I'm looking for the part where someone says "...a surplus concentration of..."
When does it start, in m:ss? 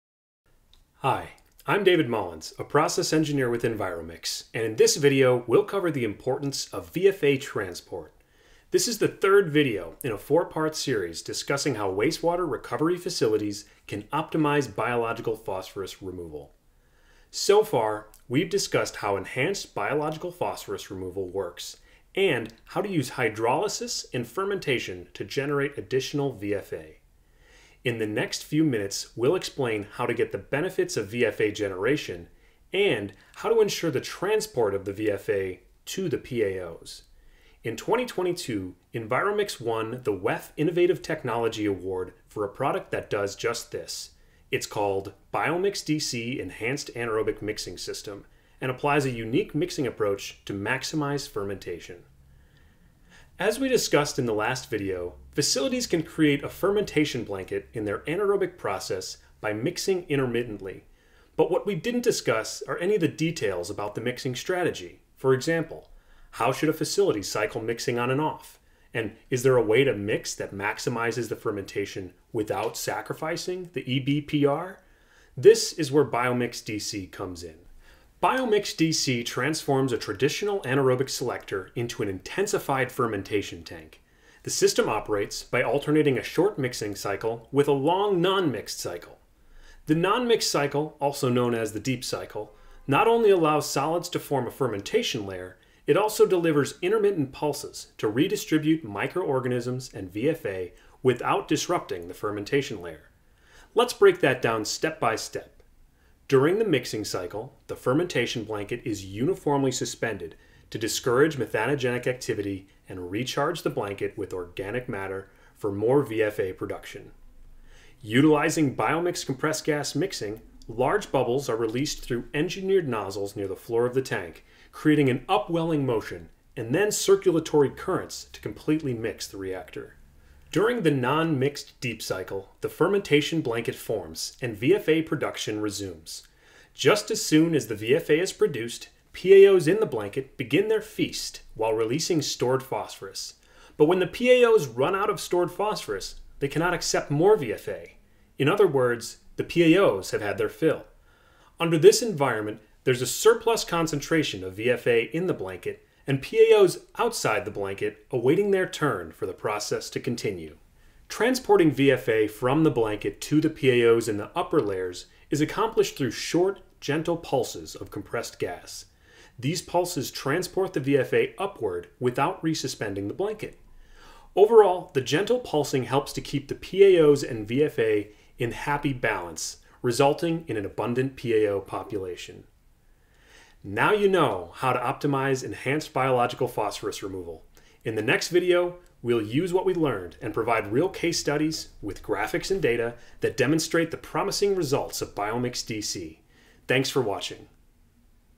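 2:33.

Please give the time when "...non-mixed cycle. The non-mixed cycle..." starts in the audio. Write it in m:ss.
1:28.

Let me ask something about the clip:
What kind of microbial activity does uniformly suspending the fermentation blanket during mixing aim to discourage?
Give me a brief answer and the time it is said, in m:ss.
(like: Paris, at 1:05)
methanogenic activity, at 1:51.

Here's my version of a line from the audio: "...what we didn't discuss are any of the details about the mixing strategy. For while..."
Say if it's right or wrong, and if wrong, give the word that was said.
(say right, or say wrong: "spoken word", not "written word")
wrong: "example", not "while".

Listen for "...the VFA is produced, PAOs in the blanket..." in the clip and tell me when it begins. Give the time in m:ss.
2:17.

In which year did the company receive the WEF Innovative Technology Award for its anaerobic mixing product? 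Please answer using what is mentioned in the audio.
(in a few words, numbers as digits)
2022.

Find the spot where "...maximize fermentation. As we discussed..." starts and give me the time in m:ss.
0:50.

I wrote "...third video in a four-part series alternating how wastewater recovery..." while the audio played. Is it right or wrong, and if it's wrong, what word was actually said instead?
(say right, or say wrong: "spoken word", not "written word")
wrong: "discussing", not "alternating".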